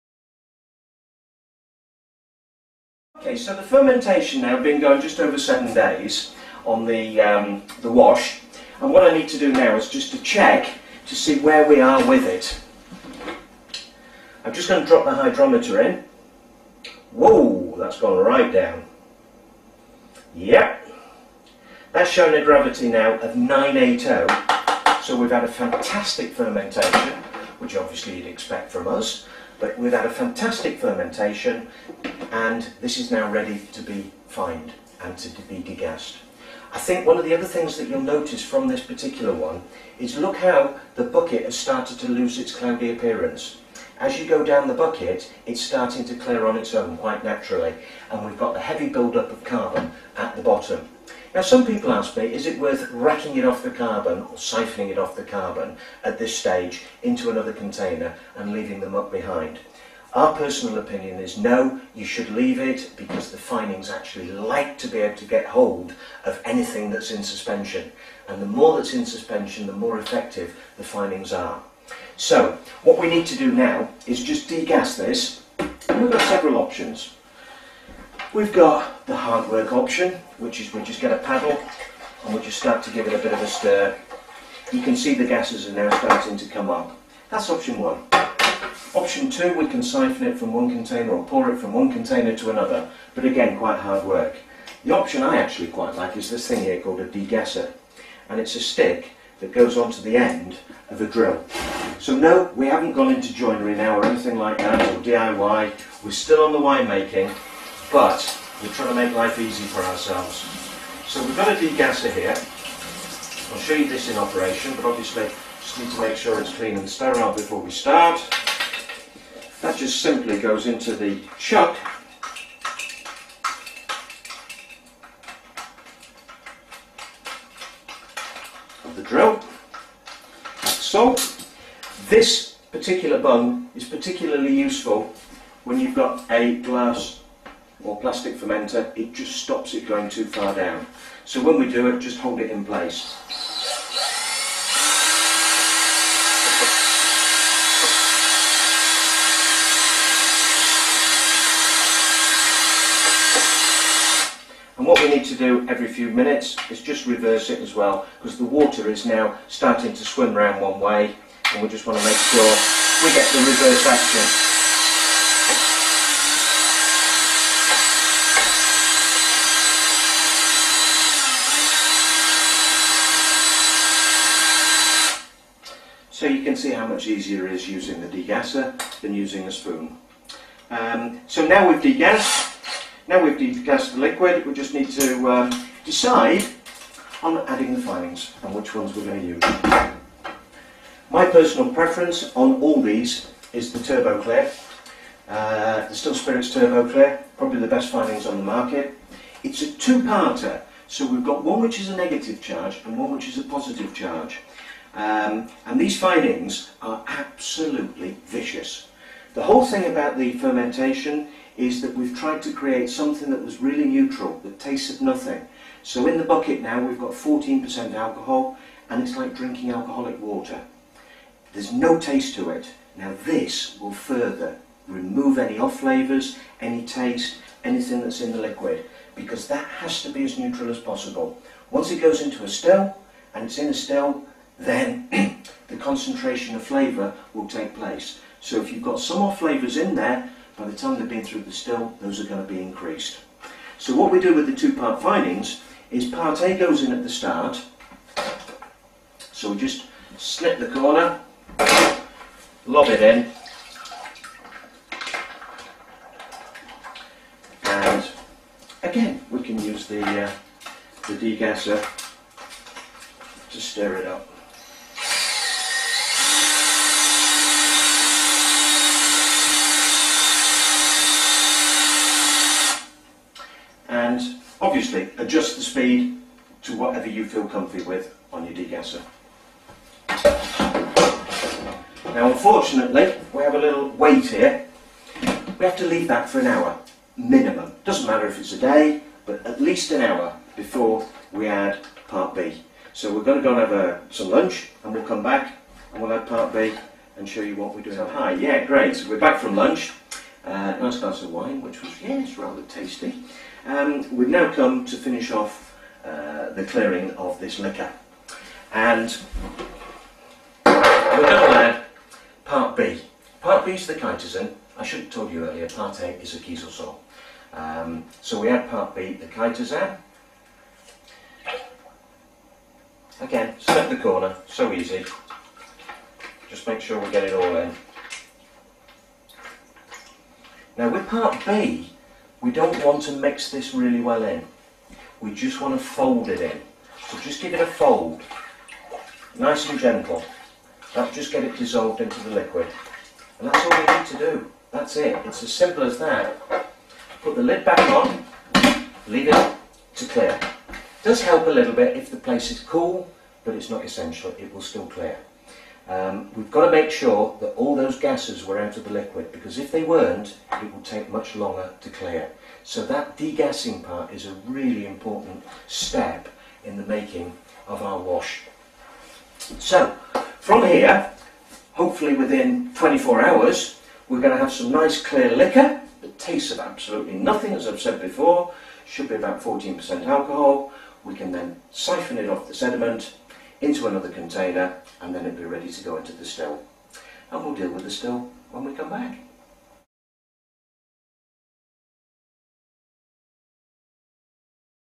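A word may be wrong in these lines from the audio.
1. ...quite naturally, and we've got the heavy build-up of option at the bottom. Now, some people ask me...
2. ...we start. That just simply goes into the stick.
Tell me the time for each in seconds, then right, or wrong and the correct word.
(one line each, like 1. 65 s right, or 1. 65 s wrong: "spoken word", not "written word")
1. 46 s wrong: "carbon", not "option"
2. 117 s wrong: "chuck", not "stick".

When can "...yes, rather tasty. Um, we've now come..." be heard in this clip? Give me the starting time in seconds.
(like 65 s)
302 s.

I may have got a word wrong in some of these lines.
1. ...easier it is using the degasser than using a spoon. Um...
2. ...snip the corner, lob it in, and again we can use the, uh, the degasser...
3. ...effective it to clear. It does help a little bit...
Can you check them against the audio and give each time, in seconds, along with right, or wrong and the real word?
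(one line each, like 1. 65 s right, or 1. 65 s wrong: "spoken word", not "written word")
1. 177 s right
2. 250 s right
3. 349 s wrong: "leave", not "effective".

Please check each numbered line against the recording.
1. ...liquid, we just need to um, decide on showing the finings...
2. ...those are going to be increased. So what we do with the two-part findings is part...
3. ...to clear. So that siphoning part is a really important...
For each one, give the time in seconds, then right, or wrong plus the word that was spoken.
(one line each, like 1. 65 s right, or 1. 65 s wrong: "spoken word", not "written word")
1. 184 s wrong: "adding", not "showing"
2. 242 s right
3. 361 s wrong: "degassing", not "siphoning".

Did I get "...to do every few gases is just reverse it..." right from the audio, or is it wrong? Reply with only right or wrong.
wrong.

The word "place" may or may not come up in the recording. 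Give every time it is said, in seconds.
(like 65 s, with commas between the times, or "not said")
142 s, 237 s, 352 s.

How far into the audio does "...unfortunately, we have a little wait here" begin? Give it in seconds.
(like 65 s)
282 s.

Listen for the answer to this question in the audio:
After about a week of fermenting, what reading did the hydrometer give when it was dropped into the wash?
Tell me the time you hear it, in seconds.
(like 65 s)
23 s.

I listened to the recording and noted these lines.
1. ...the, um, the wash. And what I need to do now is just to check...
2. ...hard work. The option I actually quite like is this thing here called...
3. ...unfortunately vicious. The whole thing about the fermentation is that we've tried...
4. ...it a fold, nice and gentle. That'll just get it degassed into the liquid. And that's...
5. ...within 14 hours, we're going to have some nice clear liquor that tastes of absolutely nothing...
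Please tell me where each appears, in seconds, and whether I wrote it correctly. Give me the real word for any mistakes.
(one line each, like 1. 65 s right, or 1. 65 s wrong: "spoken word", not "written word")
1. 6 s right
2. 93 s right
3. 207 s wrong: "absolutely", not "unfortunately"
4. 337 s wrong: "dissolved", not "degassed"
5. 372 s wrong: "24", not "14".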